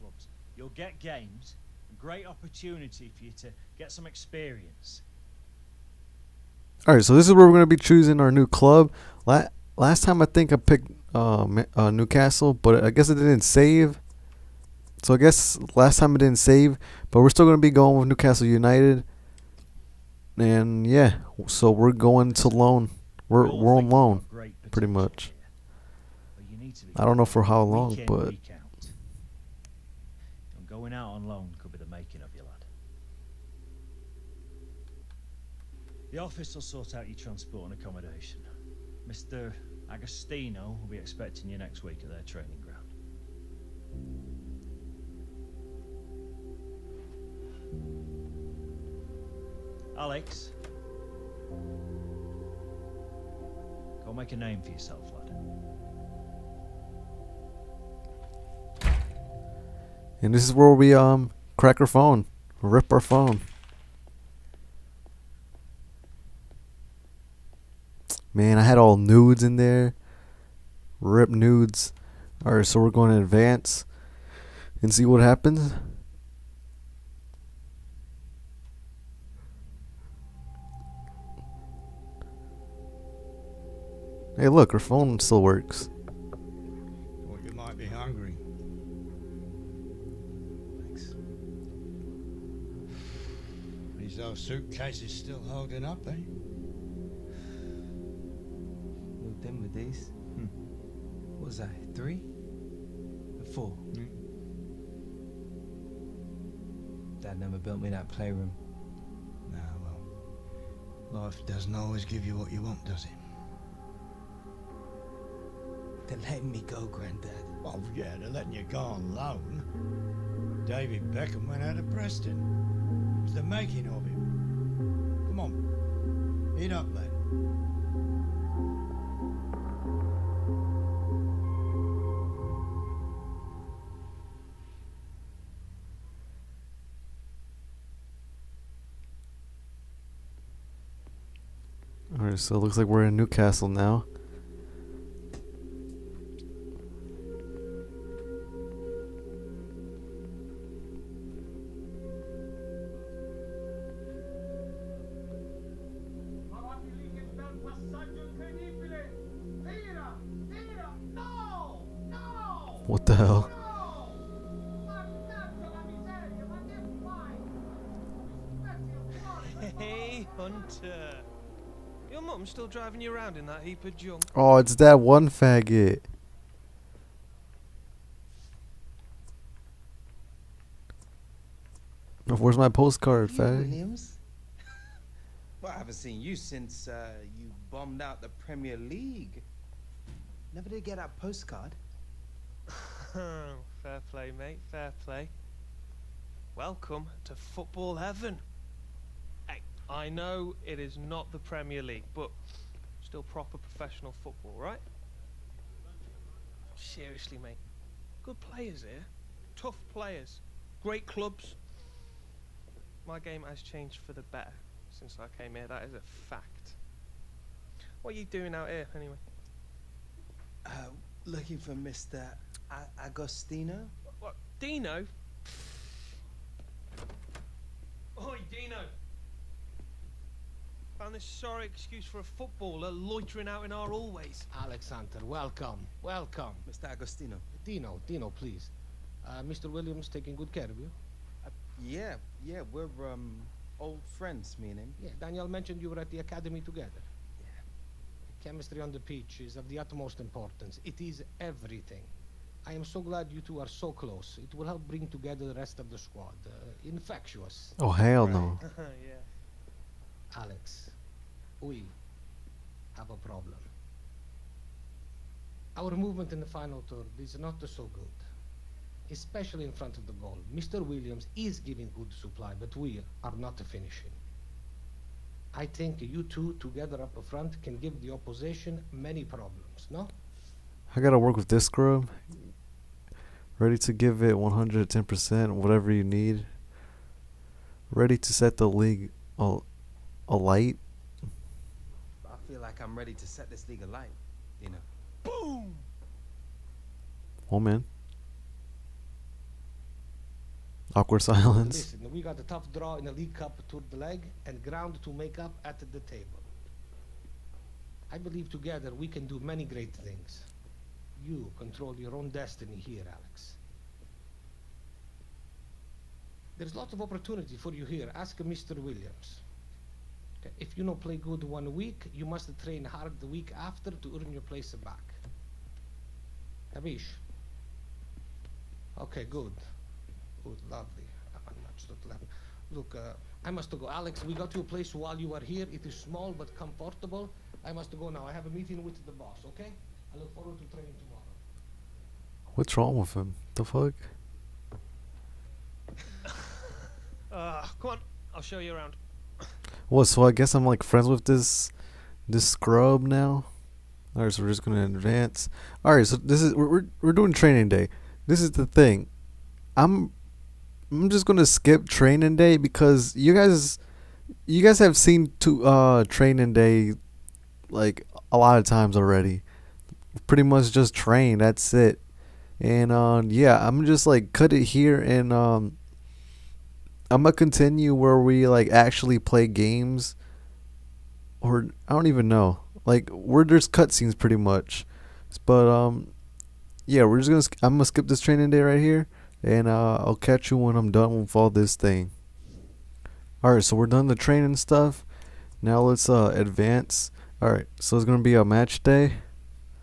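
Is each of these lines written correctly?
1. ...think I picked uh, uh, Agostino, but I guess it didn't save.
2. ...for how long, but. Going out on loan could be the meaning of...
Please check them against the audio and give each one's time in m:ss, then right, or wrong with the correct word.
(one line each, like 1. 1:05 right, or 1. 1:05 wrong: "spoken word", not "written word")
1. 0:10 wrong: "Newcastle", not "Agostino"
2. 0:27 wrong: "making", not "meaning".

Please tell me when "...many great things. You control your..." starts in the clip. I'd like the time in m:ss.
5:09.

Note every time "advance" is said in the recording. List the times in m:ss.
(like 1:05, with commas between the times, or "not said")
1:13, 5:54, 6:36.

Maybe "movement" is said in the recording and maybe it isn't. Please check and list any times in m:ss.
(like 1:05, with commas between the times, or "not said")
4:25.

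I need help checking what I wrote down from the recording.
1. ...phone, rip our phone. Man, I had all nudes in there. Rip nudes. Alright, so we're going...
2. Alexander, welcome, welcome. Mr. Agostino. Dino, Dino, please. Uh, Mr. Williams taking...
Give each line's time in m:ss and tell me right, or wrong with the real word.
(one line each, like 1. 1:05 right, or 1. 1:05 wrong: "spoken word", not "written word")
1. 1:01 right
2. 3:54 right.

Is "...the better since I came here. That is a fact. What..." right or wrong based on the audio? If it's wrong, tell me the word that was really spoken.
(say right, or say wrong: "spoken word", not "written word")
right.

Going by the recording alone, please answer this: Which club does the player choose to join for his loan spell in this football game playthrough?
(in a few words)
Newcastle United.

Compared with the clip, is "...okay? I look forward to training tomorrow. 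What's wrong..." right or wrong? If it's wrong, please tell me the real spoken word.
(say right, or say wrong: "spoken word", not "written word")
right.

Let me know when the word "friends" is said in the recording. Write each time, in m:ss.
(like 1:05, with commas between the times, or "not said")
4:04, 5:50.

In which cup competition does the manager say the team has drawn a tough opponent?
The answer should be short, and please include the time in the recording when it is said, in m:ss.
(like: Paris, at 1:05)
League Cup, at 5:03.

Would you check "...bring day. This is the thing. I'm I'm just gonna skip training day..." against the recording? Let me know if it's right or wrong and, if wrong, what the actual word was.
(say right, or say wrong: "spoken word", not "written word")
wrong: "training", not "bring".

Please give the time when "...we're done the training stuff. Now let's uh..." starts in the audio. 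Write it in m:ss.
6:33.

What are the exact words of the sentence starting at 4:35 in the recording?
I think you two together up front can give the opposition many problems, no?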